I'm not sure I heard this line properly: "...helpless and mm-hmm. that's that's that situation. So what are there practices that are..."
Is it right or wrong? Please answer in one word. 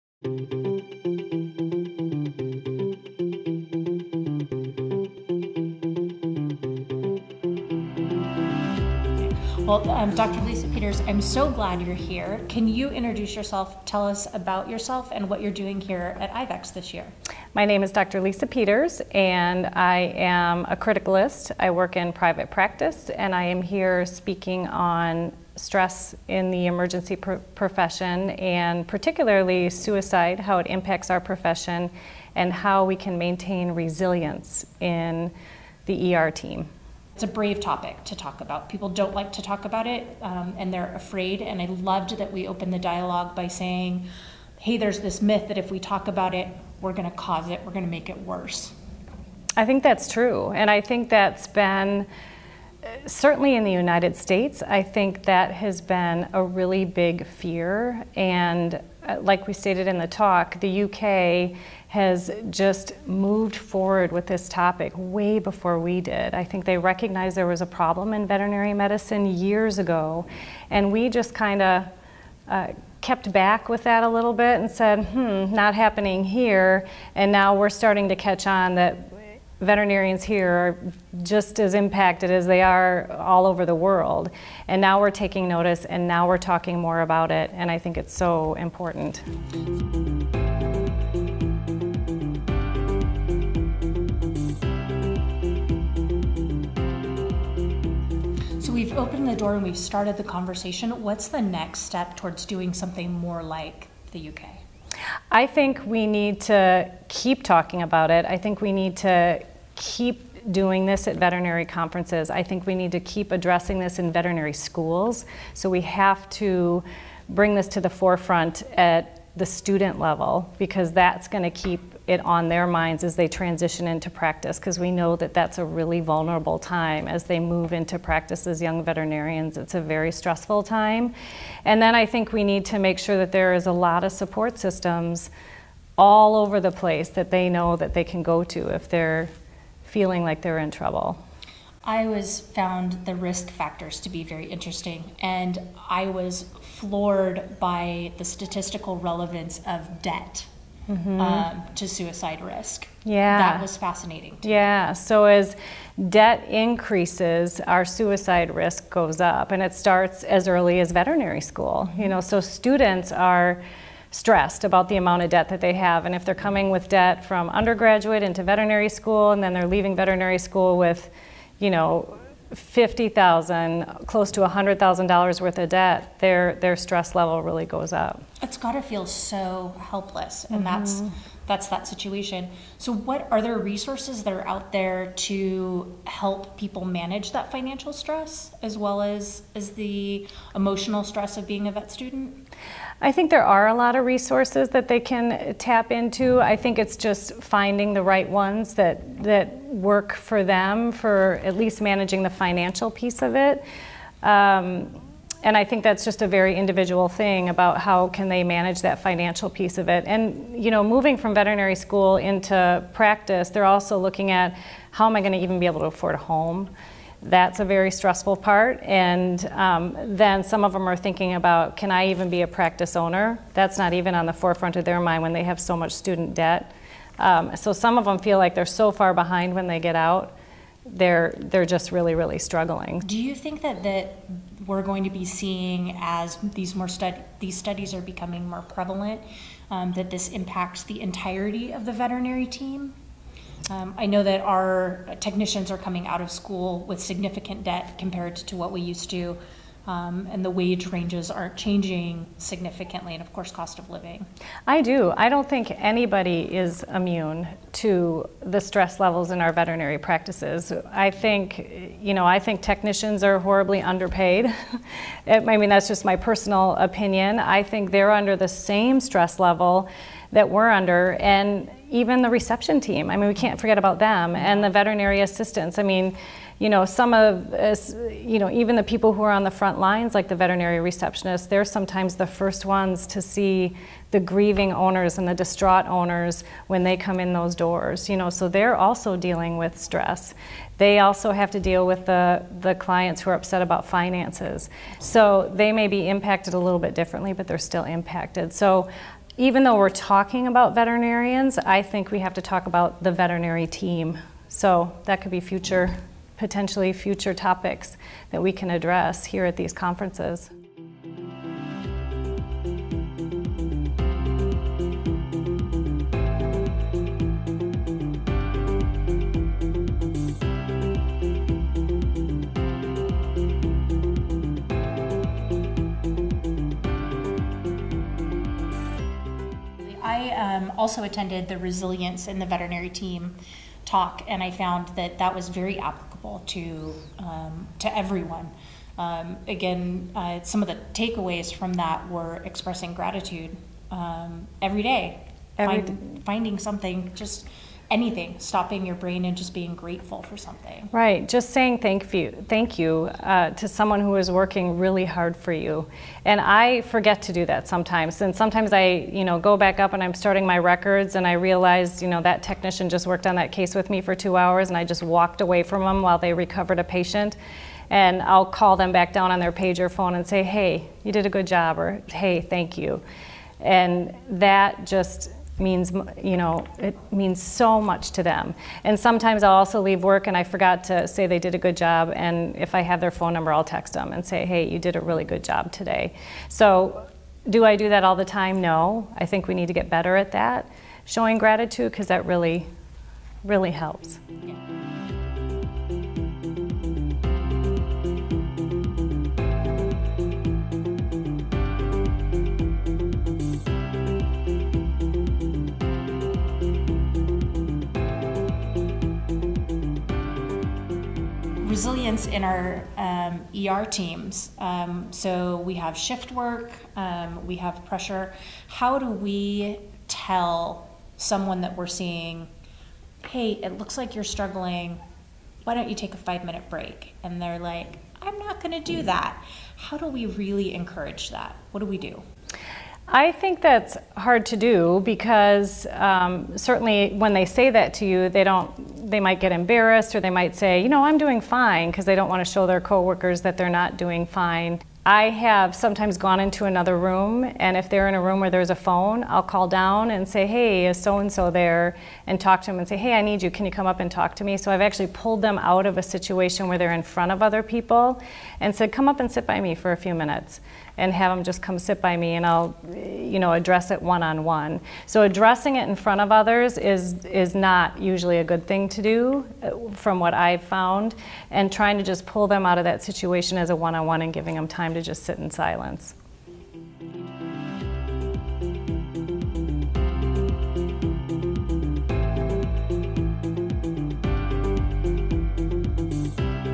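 wrong.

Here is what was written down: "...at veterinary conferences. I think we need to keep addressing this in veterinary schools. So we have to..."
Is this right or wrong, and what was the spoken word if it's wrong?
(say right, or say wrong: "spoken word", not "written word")
right.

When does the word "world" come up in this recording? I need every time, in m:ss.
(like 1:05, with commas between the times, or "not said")
1:23.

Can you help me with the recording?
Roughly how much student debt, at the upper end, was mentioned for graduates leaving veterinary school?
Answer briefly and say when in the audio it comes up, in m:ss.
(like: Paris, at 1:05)
$100,000, at 2:54.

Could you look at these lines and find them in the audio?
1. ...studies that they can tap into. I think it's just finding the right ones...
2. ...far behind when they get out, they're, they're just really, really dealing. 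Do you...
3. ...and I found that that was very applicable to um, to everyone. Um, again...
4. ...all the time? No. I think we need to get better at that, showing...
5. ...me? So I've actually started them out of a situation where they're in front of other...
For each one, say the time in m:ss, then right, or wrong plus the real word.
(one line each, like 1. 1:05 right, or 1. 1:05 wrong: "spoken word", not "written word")
1. 3:14 wrong: "resources", not "studies"
2. 3:48 wrong: "struggling", not "dealing"
3. 5:34 right
4. 6:28 right
5. 7:34 wrong: "pulled", not "started".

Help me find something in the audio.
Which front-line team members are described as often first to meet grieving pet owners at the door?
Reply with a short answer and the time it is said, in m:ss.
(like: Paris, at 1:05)
Veterinary receptionists, at 4:40.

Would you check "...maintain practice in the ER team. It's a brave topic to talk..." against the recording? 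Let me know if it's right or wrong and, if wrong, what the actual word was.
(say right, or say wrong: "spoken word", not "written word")
wrong: "resilience", not "practice".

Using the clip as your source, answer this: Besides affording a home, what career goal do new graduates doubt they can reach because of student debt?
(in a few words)
Practice owner.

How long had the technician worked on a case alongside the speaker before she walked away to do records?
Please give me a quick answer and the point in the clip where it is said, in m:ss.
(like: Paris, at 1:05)
2 hours, at 6:04.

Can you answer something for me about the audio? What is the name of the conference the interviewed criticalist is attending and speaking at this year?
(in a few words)
IVECCS.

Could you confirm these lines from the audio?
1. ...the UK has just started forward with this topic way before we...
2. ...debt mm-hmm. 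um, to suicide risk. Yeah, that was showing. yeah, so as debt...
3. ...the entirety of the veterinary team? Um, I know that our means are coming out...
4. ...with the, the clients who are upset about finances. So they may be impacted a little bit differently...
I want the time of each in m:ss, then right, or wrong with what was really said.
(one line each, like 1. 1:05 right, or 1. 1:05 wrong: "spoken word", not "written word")
1. 1:00 wrong: "moved", not "started"
2. 2:30 wrong: "fascinating", not "showing"
3. 4:00 wrong: "technicians", not "means"
4. 4:51 right.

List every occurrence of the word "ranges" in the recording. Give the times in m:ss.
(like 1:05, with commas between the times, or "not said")
4:10.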